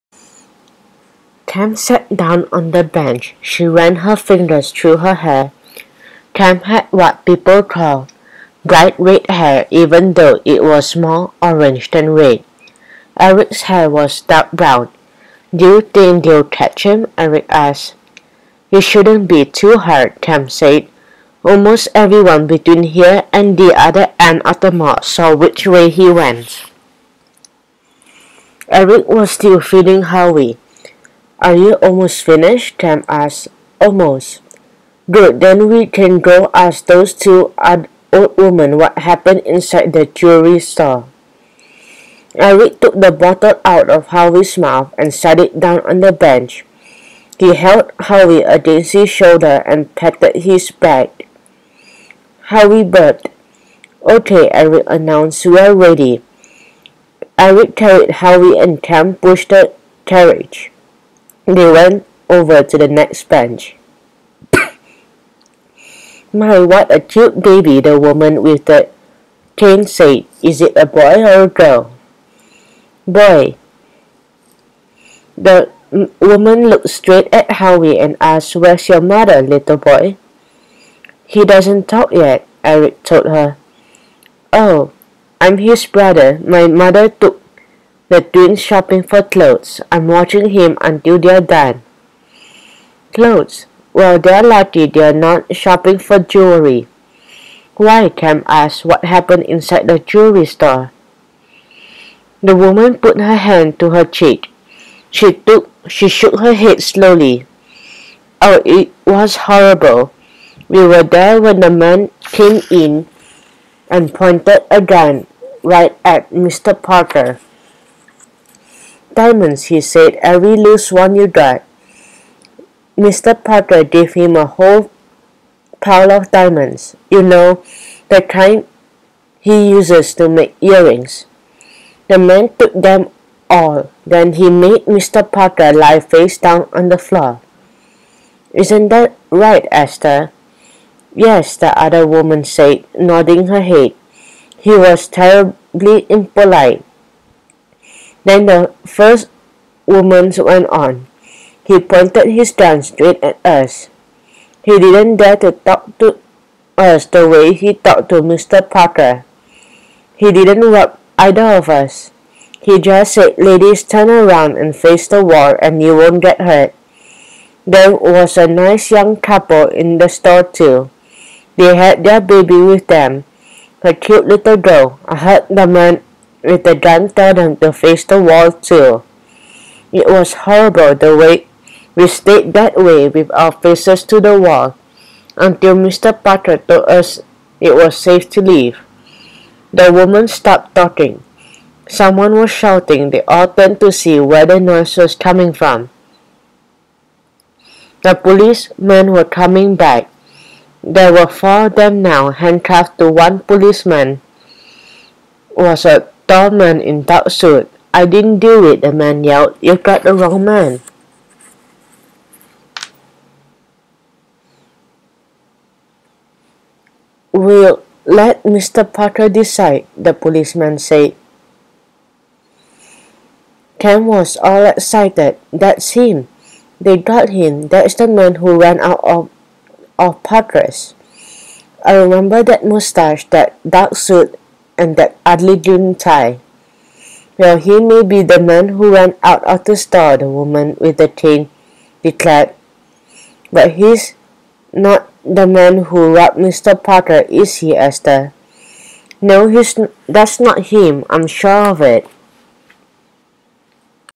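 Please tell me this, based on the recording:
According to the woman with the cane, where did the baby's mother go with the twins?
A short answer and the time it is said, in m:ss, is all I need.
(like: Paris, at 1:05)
Shopping for clothes, at 1:28.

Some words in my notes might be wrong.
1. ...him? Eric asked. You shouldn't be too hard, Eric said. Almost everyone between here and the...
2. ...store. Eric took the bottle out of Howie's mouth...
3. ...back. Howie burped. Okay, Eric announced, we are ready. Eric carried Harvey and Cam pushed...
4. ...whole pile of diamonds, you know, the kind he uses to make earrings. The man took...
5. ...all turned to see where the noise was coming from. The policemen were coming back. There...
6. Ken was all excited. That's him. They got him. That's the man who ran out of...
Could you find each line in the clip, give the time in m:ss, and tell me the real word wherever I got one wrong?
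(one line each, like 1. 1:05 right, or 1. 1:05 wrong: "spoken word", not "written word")
1. 0:16 wrong: "Cam", not "Eric"
2. 0:40 right
3. 0:50 right
4. 2:04 right
5. 3:13 right
6. 3:43 right.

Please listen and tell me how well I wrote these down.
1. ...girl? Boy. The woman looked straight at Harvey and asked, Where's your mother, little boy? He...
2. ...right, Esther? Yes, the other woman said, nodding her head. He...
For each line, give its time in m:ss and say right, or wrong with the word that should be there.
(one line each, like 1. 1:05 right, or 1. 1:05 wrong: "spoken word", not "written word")
1. 1:11 wrong: "Howie", not "Harvey"
2. 2:19 right.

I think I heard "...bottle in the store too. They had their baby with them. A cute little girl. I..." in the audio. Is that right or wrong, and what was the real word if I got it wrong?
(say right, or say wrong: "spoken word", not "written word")
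wrong: "couple", not "bottle".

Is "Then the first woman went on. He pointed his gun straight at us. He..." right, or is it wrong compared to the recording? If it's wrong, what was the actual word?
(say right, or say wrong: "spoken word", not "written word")
right.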